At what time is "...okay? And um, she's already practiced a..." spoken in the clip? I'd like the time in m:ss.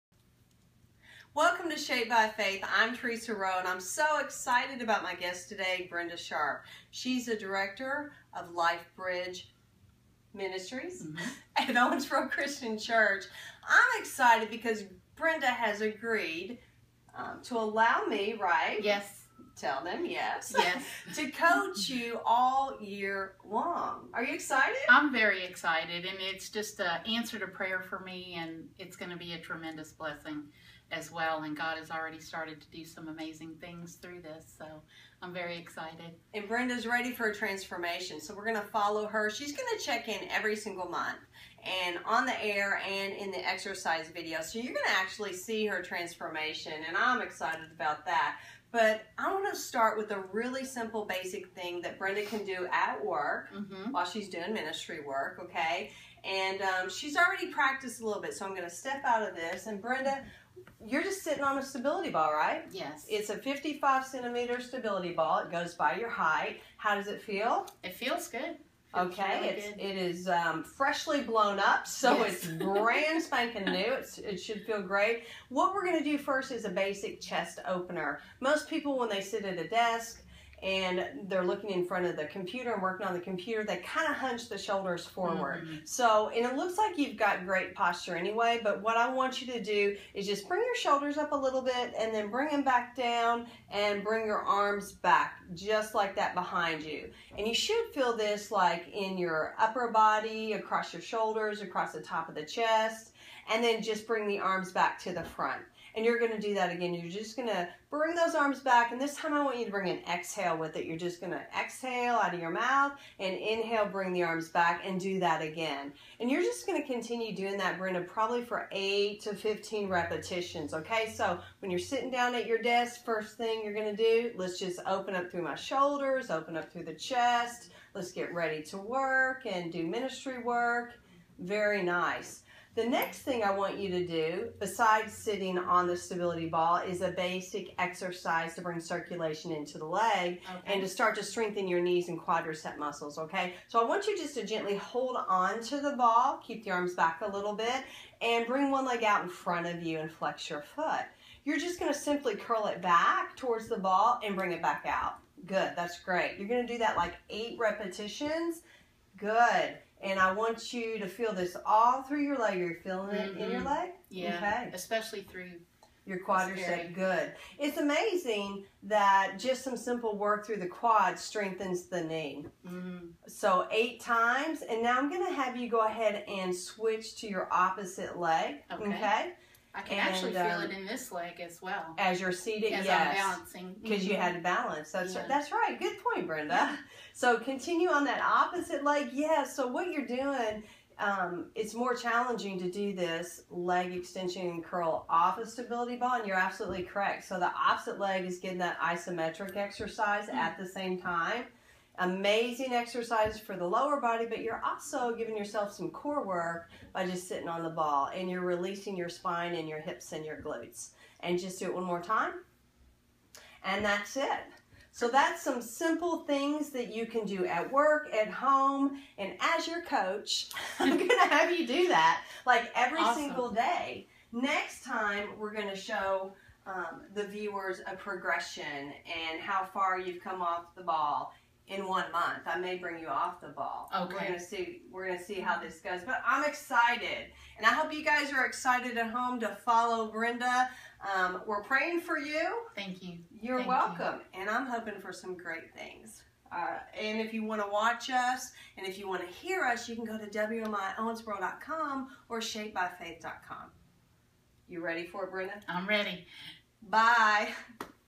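0:55.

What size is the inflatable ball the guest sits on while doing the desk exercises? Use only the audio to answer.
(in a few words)
55 centimeters.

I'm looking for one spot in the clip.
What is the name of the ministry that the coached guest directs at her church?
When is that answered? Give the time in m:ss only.
0:08.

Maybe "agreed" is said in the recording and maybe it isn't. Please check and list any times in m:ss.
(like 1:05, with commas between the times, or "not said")
0:15.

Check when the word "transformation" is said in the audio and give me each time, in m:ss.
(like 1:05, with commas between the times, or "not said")
0:37, 0:45.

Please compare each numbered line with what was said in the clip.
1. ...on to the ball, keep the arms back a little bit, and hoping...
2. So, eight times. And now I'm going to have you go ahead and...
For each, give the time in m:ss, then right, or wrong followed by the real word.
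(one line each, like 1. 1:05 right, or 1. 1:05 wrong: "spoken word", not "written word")
1. 2:25 wrong: "bring", not "hoping"
2. 2:53 right.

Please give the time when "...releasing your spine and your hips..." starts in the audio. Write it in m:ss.
3:28.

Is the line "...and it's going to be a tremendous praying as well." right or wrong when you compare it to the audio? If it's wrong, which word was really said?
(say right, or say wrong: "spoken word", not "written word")
wrong: "blessing", not "praying".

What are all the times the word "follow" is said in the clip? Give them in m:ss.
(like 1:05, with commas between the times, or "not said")
0:38, 3:59.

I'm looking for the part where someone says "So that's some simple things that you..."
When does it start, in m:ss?
3:34.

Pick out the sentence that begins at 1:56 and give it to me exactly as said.
And you're just gonna continue doing that, Brenda, probably for eight to 15 repetitions, okay?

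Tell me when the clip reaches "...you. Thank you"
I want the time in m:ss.
4:02.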